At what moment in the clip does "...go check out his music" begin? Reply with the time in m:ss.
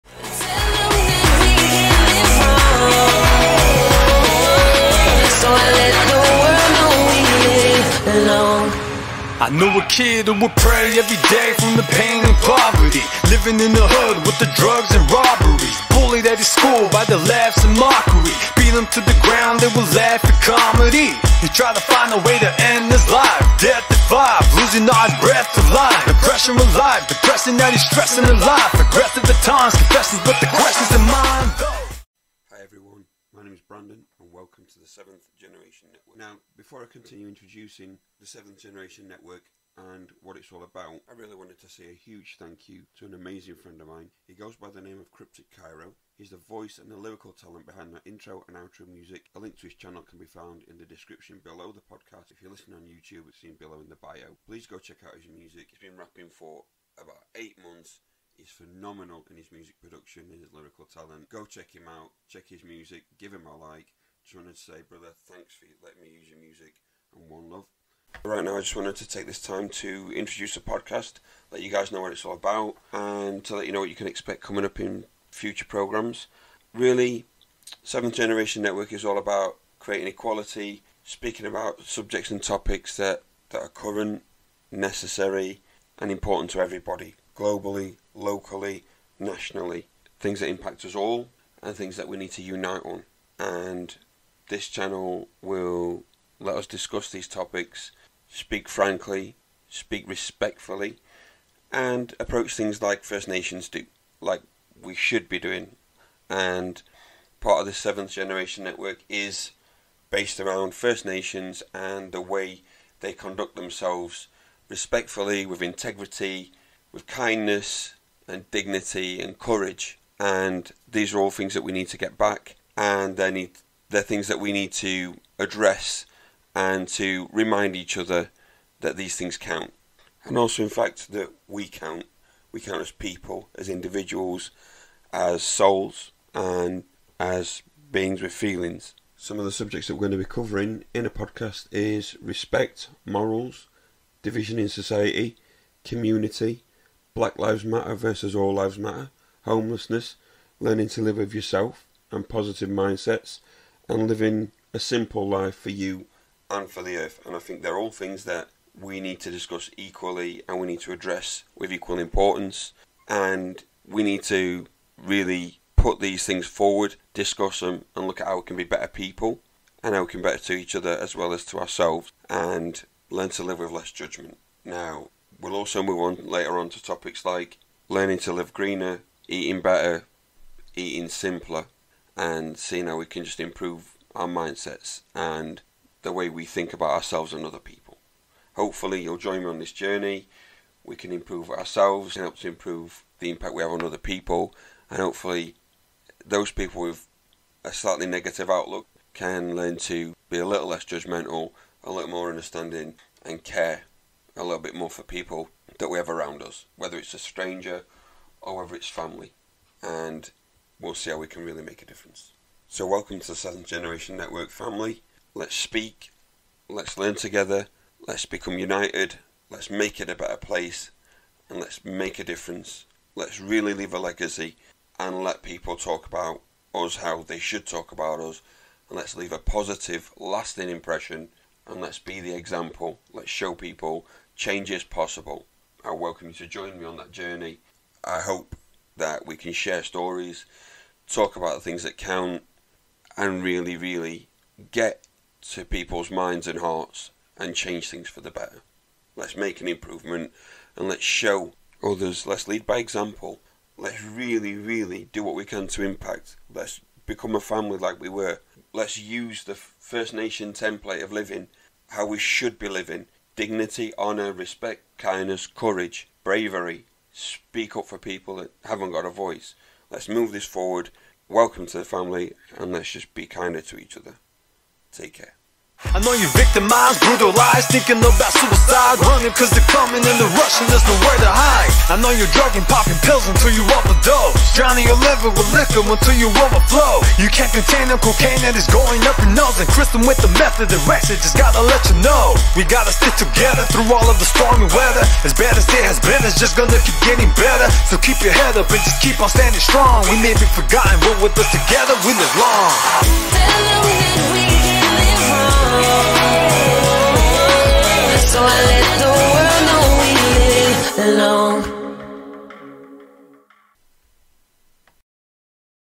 0:54.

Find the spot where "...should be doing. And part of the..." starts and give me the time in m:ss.
1:44.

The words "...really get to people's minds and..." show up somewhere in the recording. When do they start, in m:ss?
4:03.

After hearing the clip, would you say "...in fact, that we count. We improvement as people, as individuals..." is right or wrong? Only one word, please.
wrong.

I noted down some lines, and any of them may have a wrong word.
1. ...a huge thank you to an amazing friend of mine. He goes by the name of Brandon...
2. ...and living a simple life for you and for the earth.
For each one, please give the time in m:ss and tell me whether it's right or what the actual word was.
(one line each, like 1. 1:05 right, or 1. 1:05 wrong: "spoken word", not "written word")
1. 0:41 wrong: "Cryptic", not "Brandon"
2. 2:33 right.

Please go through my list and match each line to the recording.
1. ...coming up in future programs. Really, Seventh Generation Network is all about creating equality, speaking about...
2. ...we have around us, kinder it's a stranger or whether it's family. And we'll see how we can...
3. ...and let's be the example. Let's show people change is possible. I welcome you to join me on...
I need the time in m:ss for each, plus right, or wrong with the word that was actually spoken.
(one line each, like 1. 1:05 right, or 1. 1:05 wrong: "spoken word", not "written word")
1. 1:14 right
2. 3:25 wrong: "whether", not "kinder"
3. 3:51 right.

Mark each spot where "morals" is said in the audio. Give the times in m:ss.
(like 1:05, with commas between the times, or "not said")
2:23.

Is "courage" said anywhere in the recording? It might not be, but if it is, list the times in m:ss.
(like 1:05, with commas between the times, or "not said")
1:59, 4:25.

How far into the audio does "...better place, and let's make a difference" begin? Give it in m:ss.
3:40.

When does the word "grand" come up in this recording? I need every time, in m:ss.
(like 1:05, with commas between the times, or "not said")
not said.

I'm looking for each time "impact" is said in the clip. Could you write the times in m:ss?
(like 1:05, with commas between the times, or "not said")
1:30, 3:13, 4:15.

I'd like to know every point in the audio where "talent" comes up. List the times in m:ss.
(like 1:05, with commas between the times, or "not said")
0:47, 1:00.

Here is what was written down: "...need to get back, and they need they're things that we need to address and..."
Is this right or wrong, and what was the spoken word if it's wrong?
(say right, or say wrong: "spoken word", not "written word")
right.